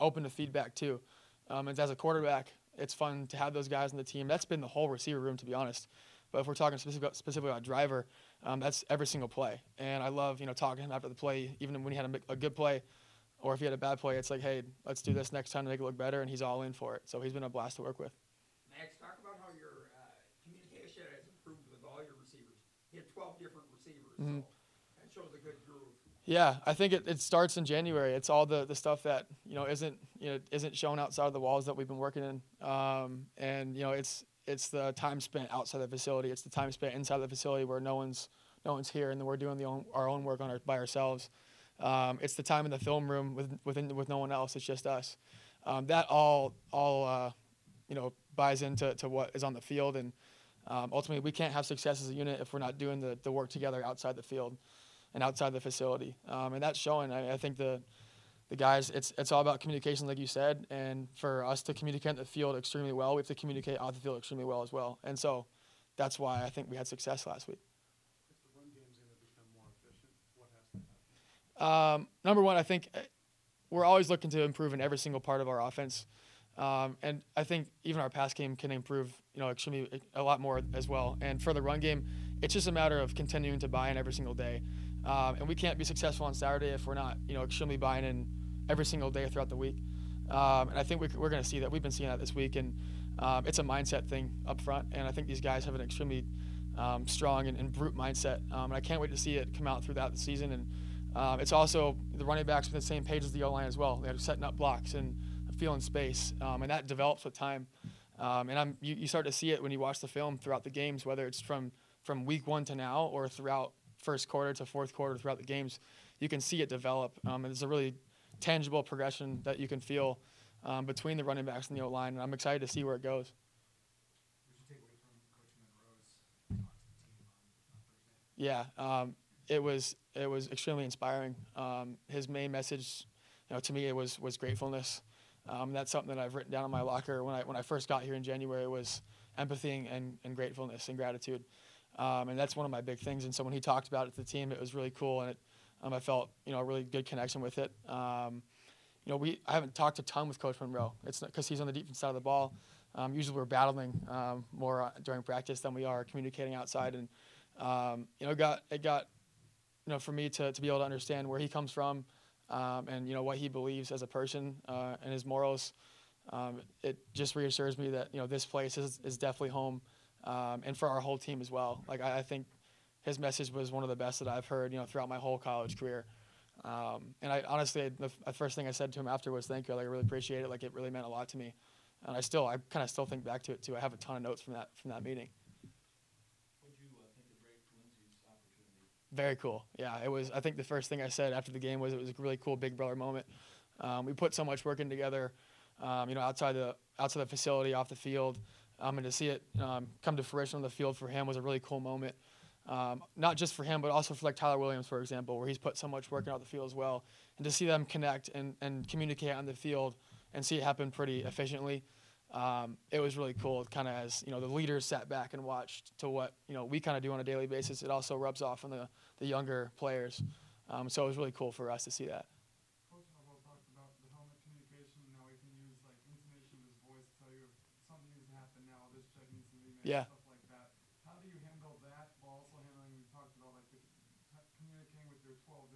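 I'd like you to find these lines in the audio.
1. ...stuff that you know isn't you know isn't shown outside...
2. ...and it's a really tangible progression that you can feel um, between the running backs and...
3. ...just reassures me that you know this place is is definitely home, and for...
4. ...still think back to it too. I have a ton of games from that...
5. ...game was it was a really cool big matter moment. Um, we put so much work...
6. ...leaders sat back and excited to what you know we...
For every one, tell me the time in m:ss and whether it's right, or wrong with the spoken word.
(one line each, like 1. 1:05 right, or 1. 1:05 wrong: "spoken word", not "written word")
1. 0:28 right
2. 1:57 right
3. 2:47 right
4. 3:02 wrong: "notes", not "games"
5. 3:11 wrong: "brother", not "matter"
6. 3:34 wrong: "watched", not "excited".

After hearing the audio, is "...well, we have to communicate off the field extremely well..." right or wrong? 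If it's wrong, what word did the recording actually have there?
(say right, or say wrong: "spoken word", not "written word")
right.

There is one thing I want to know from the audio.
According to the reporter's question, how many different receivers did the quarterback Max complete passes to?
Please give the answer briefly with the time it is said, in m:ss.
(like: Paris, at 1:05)
12, at 0:23.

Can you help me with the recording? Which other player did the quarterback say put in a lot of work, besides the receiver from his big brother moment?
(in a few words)
Tyler Williams.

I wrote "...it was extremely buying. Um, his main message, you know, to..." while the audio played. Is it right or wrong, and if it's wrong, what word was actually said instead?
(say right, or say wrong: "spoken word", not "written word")
wrong: "inspiring", not "buying".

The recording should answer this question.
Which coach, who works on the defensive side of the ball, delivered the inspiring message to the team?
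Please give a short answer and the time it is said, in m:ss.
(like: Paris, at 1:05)
Coach Monroe, at 2:30.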